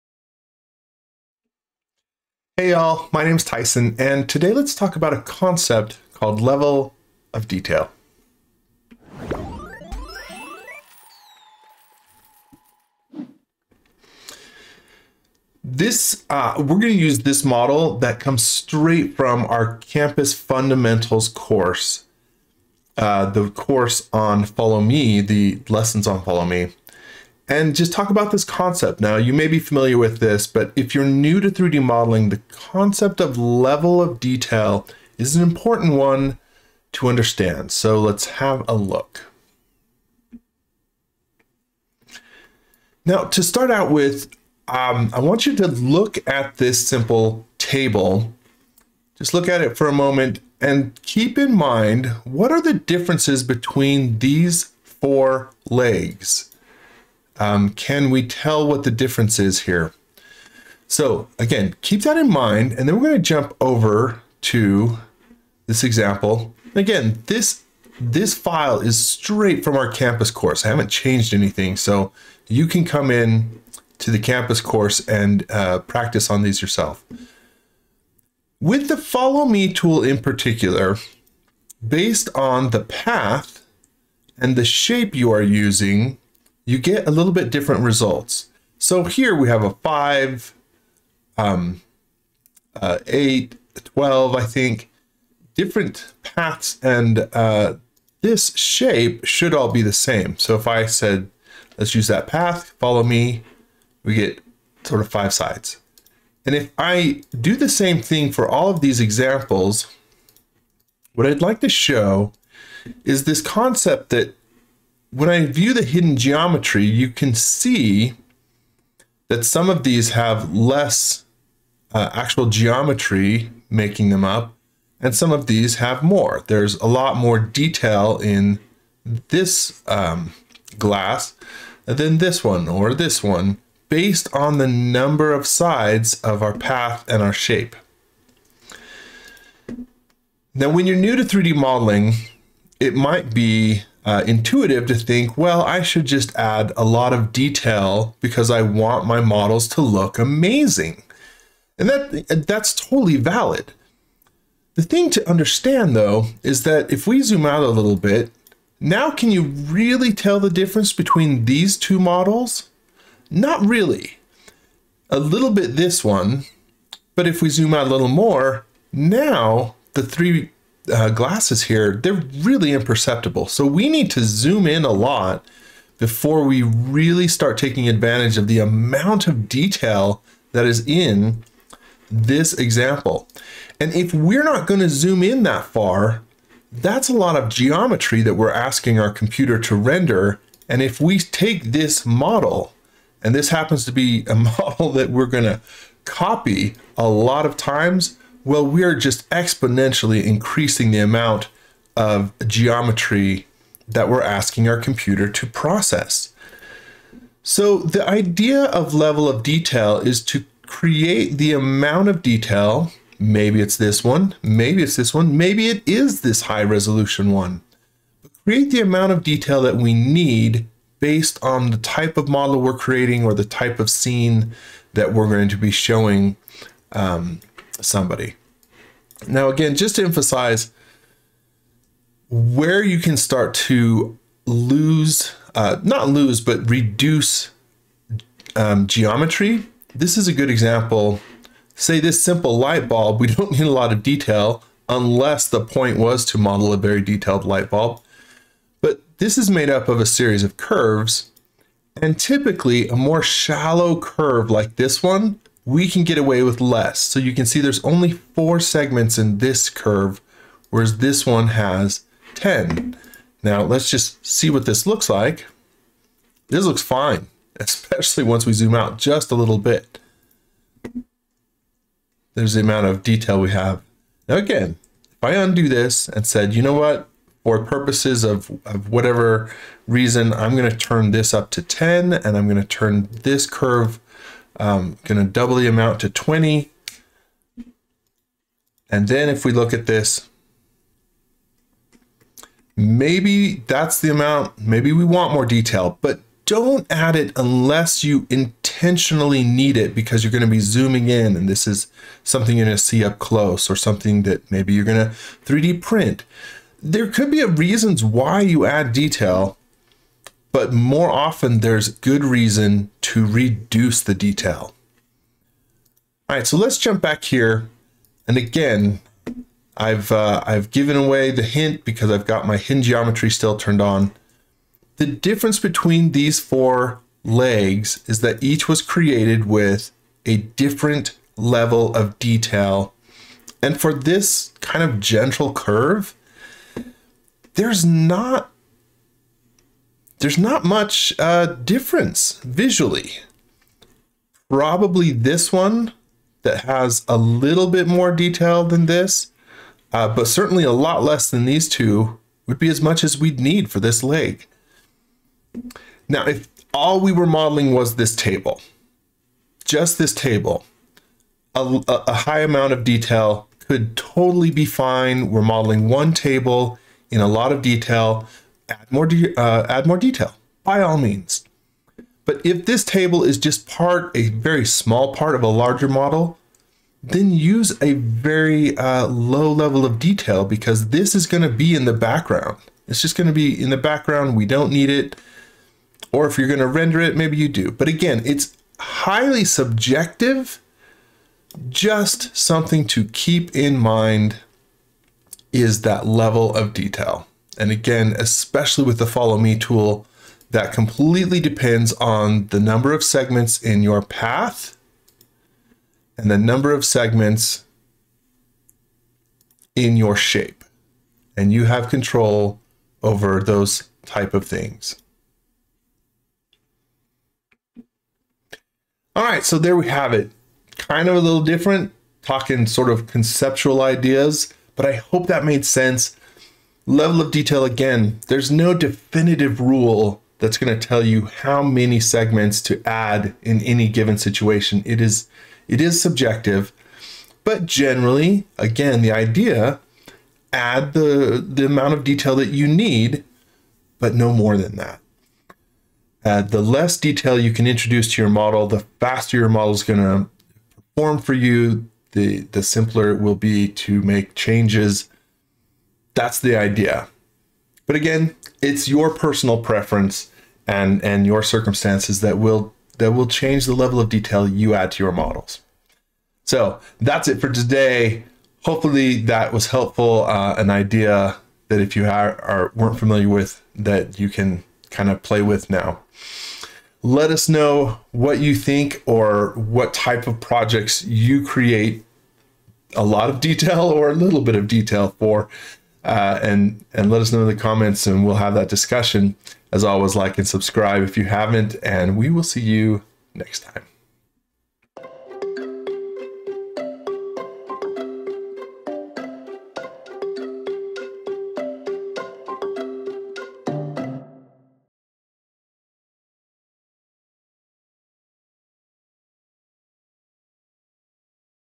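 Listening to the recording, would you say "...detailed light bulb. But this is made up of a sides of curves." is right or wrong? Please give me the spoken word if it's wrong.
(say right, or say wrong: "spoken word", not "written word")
wrong: "series", not "sides".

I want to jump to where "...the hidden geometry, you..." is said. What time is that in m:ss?
1:55.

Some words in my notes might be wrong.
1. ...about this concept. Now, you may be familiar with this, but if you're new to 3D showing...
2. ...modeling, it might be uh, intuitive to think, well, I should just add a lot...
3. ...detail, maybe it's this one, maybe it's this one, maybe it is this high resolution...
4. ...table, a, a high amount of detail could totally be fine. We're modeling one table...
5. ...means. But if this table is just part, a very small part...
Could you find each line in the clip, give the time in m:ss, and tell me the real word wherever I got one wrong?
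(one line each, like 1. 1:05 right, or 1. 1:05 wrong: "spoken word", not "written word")
1. 0:28 wrong: "modeling", not "showing"
2. 2:21 right
3. 3:32 right
4. 6:00 right
5. 6:10 right.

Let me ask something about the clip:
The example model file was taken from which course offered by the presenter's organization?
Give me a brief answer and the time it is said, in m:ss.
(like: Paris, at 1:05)
Campus Fundamentals, at 0:19.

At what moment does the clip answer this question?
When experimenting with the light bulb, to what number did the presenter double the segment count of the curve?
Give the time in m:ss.
4:46.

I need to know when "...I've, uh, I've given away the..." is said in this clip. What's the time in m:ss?
5:19.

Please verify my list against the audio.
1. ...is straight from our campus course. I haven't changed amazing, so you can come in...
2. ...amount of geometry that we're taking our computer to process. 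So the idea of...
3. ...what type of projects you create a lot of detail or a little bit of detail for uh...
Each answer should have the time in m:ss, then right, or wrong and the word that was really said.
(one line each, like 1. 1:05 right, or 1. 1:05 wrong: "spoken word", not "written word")
1. 1:08 wrong: "anything", not "amazing"
2. 3:20 wrong: "asking", not "taking"
3. 7:59 right.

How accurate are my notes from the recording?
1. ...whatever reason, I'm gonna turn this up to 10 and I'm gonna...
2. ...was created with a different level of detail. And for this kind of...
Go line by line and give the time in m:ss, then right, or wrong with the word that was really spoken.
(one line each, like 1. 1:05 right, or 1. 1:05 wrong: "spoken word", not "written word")
1. 4:38 right
2. 5:28 right.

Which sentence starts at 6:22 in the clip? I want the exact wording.
It's just going to be in the background.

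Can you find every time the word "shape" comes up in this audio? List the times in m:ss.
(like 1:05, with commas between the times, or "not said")
1:24, 1:38, 2:17, 6:50.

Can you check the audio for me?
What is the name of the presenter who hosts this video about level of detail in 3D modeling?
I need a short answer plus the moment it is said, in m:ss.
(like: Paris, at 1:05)
Tyson, at 0:03.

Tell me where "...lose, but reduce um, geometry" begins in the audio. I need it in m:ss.
3:56.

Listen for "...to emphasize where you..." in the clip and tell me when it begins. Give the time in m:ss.
3:49.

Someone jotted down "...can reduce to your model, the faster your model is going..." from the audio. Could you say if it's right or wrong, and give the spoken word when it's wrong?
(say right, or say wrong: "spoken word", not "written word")
wrong: "introduce", not "reduce".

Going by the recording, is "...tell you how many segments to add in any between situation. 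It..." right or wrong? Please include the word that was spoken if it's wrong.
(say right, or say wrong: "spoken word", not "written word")
wrong: "given", not "between".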